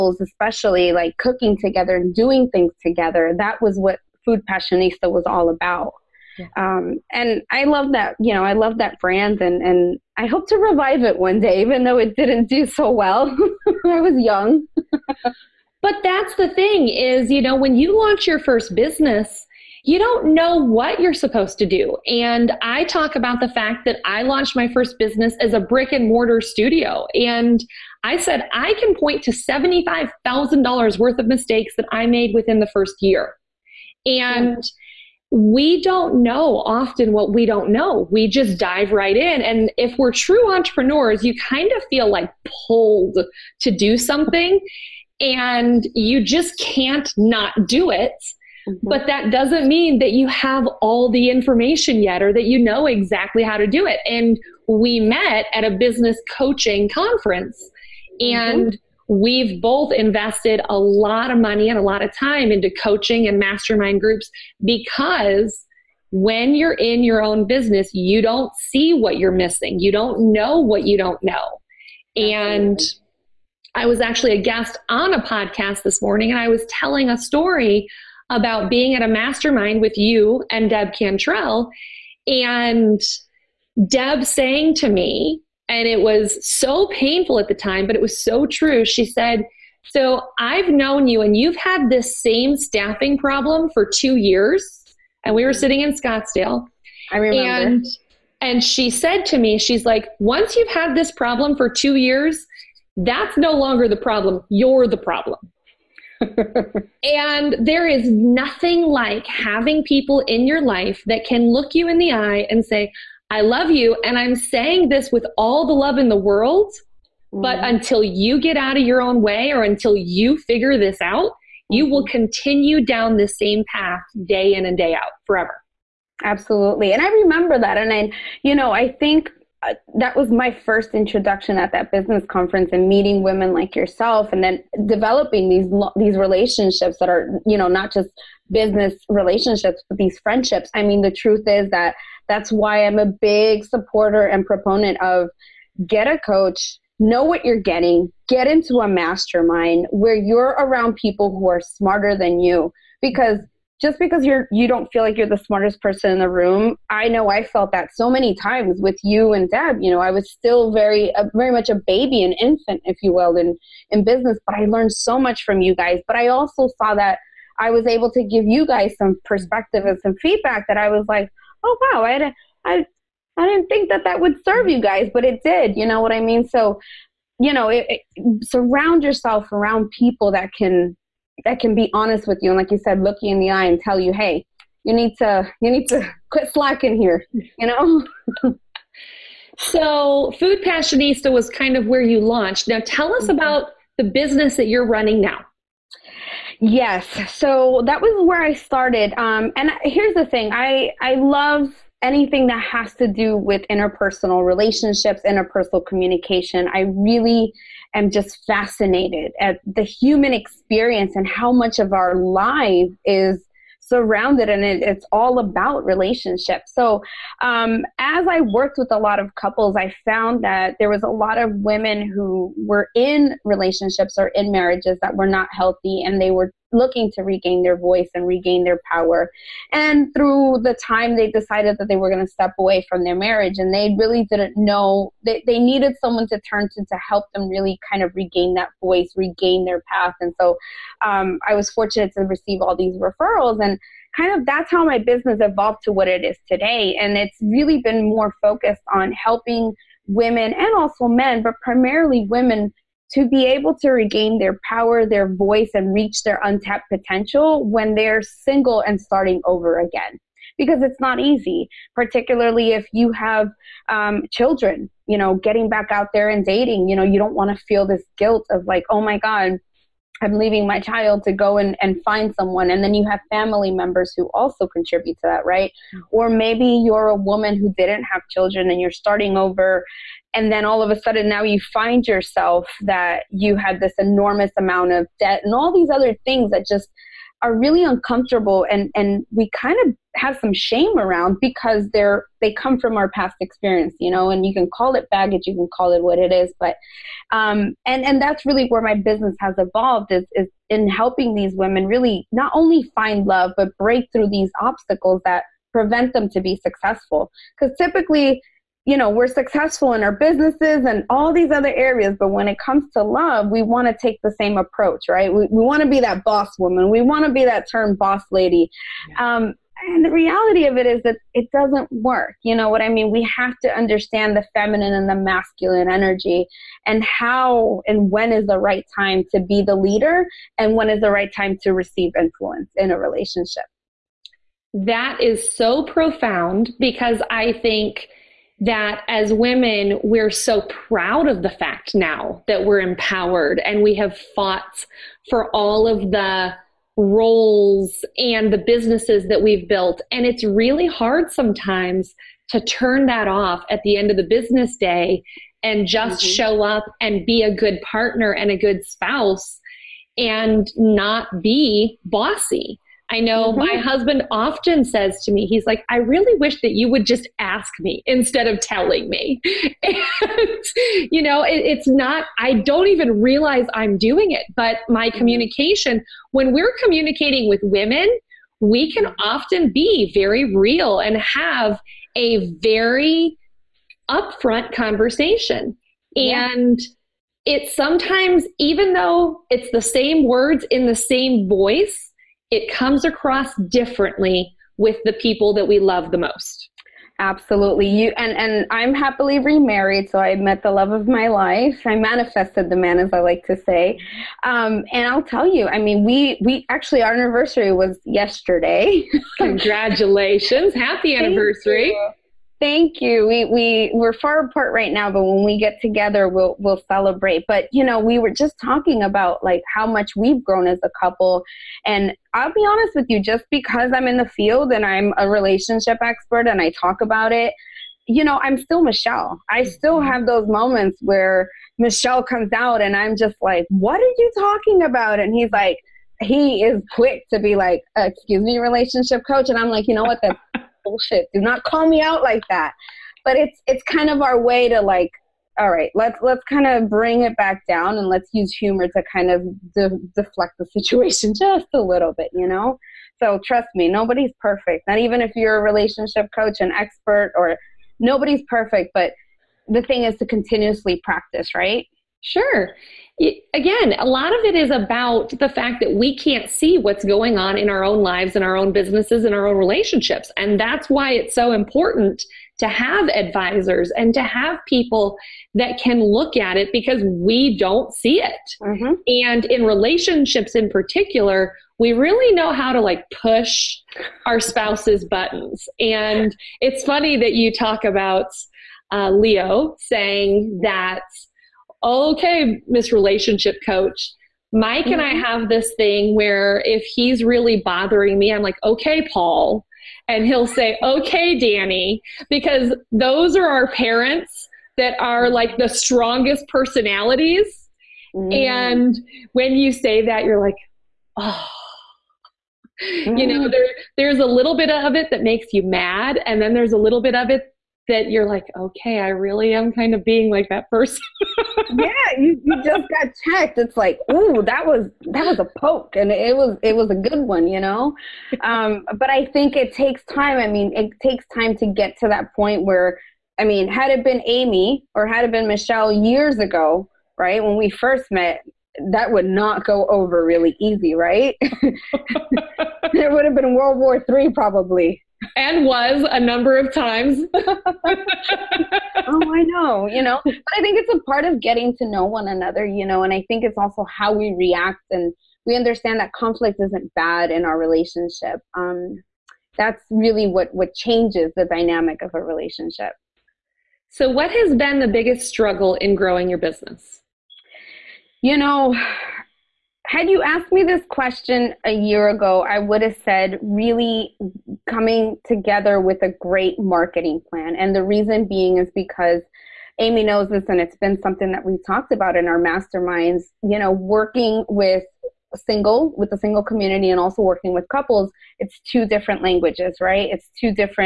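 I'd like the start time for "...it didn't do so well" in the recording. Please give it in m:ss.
0:11.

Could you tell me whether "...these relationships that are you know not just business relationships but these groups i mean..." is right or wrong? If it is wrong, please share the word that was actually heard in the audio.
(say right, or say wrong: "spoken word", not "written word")
wrong: "friendships", not "groups".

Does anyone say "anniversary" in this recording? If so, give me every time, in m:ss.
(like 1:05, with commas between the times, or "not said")
6:47, 6:51.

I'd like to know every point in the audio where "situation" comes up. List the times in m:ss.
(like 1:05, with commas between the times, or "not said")
7:30.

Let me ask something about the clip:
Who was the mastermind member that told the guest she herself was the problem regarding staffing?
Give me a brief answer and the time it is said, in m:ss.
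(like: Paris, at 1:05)
Deb Cantrell, at 1:20.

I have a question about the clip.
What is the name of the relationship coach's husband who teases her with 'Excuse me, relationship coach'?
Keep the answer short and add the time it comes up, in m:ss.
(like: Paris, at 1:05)
Leo, at 8:09.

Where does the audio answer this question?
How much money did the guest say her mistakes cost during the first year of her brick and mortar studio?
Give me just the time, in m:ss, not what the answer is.
0:29.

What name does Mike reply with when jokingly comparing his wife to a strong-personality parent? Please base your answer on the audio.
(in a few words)
Danny.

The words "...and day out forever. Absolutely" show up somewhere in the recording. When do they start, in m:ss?
2:04.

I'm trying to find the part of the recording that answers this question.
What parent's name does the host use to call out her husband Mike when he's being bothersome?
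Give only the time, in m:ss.
8:19.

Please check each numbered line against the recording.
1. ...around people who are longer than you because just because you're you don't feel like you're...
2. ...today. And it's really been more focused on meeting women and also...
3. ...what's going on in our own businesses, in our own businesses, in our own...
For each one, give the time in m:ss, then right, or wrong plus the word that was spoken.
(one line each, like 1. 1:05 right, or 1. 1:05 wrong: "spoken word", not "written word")
1. 2:30 wrong: "smarter", not "longer"
2. 4:06 wrong: "helping", not "meeting"
3. 7:46 wrong: "lives", not "businesses".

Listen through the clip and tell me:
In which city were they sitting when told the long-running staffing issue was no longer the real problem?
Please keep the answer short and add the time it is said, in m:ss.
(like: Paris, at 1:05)
Scottsdale, at 1:35.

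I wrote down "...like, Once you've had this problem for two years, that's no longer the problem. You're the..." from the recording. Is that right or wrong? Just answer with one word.
right.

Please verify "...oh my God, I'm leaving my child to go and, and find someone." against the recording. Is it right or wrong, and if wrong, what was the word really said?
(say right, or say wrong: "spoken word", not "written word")
right.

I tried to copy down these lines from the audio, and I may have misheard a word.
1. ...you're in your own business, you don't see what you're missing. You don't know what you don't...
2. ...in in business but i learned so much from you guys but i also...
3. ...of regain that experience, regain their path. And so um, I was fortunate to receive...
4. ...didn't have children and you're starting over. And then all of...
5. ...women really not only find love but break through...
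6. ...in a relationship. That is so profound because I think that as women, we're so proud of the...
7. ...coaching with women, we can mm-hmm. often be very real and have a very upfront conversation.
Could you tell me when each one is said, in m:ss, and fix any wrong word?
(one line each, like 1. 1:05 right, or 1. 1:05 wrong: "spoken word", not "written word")
1. 1:06 right
2. 2:43 right
3. 3:58 wrong: "voice", not "experience"
4. 4:37 right
5. 5:01 right
6. 5:32 right
7. 6:16 wrong: "communicating", not "coaching".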